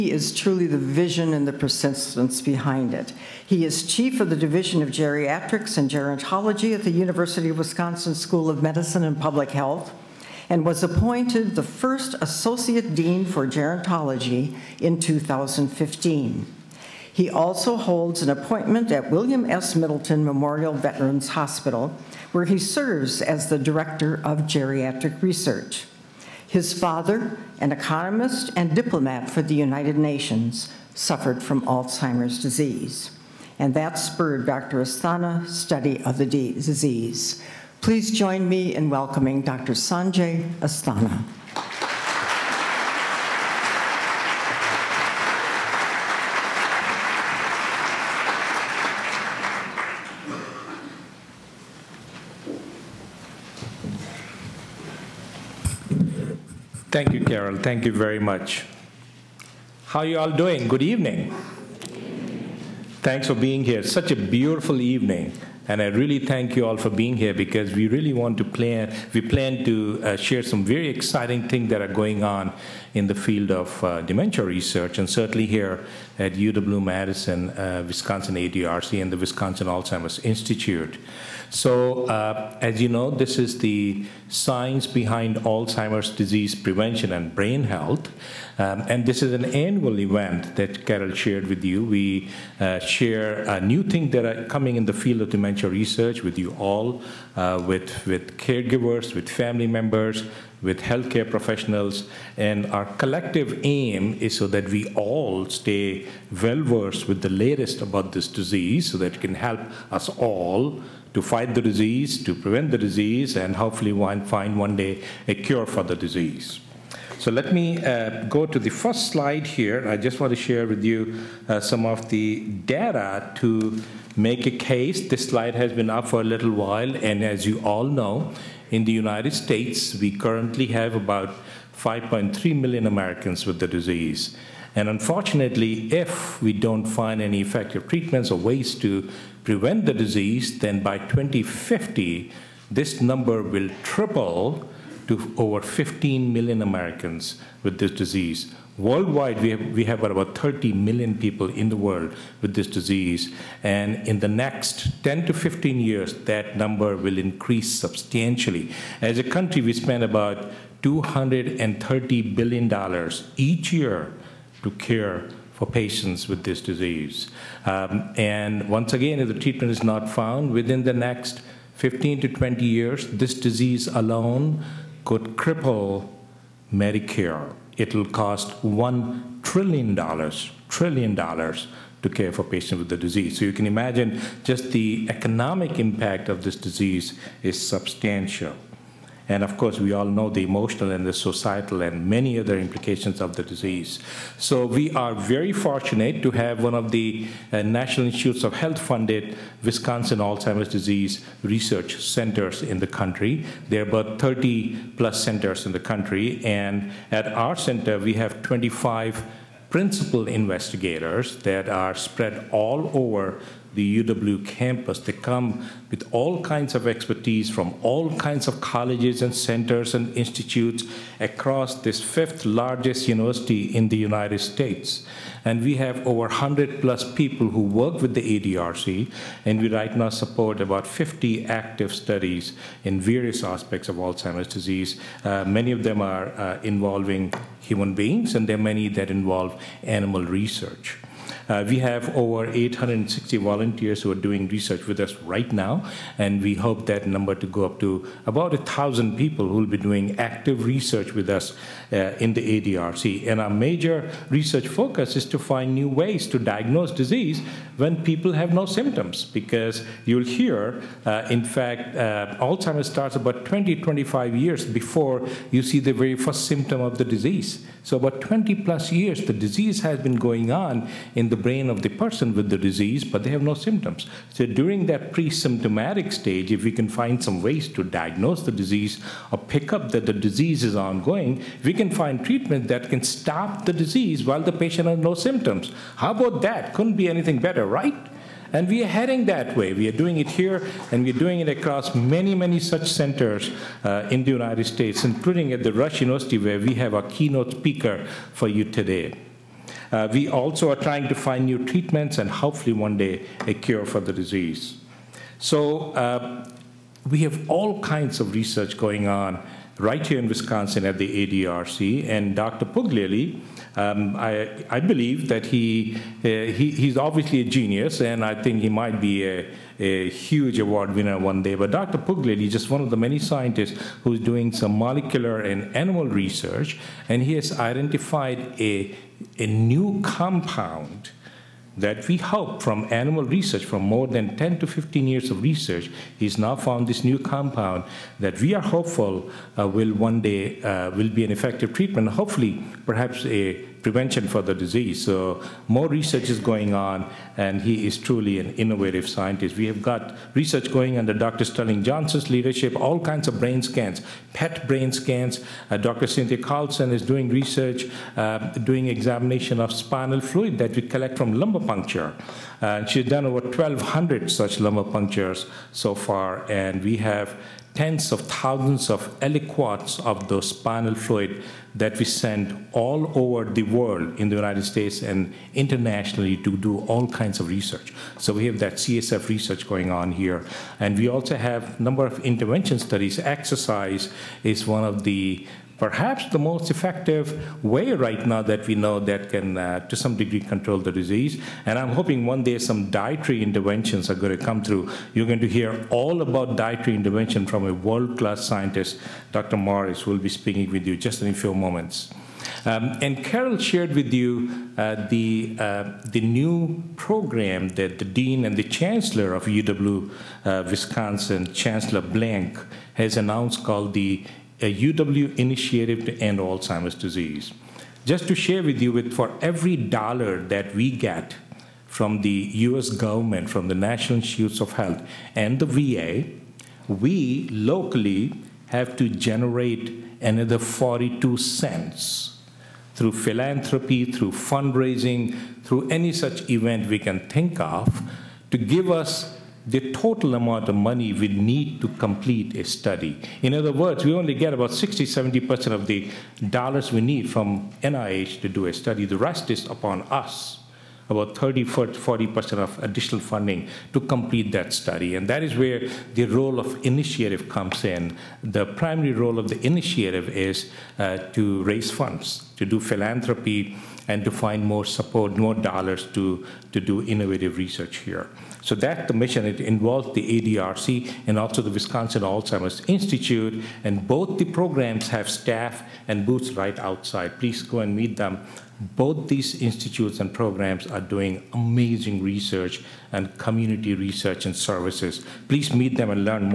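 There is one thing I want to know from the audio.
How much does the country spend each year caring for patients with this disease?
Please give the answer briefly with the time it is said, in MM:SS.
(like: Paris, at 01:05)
$230 billion, at 02:40.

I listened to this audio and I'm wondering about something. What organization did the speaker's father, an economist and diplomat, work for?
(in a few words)
United Nations.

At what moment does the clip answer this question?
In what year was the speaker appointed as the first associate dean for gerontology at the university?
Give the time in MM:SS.
00:15.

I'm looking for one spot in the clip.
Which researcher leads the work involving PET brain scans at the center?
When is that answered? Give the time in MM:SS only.
05:51.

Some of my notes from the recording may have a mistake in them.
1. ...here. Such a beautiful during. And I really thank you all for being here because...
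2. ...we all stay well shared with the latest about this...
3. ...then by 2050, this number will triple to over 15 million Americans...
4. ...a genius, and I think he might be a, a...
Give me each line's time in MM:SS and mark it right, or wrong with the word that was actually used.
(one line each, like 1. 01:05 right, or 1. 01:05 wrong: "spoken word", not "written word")
1. 01:03 wrong: "evening", not "during"
2. 01:44 wrong: "versed", not "shared"
3. 02:20 right
4. 05:17 right.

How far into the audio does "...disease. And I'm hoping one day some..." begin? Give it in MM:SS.
06:30.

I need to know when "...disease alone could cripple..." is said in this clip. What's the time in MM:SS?
02:53.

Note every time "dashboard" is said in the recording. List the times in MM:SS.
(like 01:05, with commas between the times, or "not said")
not said.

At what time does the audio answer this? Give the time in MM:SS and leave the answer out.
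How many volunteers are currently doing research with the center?
04:02.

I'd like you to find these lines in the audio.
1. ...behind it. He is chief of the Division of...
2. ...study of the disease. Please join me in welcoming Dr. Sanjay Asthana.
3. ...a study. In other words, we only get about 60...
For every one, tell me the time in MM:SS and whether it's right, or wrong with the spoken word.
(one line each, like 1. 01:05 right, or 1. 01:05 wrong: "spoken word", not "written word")
1. 00:02 right
2. 00:35 right
3. 07:22 right.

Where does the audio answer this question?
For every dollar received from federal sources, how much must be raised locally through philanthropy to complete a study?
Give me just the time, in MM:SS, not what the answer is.
07:10.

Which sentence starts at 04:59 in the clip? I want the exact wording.
Uh, we also are trying to find new treatments and hopefully one day a cure for the disease.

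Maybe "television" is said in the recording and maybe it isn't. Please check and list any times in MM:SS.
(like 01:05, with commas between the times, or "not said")
not said.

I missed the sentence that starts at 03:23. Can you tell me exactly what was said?
There are about 30 plus centers in the country.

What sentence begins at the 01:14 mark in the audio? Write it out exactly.
And certainly here at UW-Madison, uh, Wisconsin ADRC, and the Wisconsin Alzheimer's Institute.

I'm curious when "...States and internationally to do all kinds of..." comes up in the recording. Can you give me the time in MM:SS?
06:14.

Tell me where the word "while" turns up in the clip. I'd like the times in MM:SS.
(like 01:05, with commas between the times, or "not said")
02:06, 04:44.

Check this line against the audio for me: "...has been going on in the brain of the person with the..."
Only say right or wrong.
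right.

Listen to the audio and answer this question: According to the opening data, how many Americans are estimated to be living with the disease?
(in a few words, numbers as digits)
5.3 million.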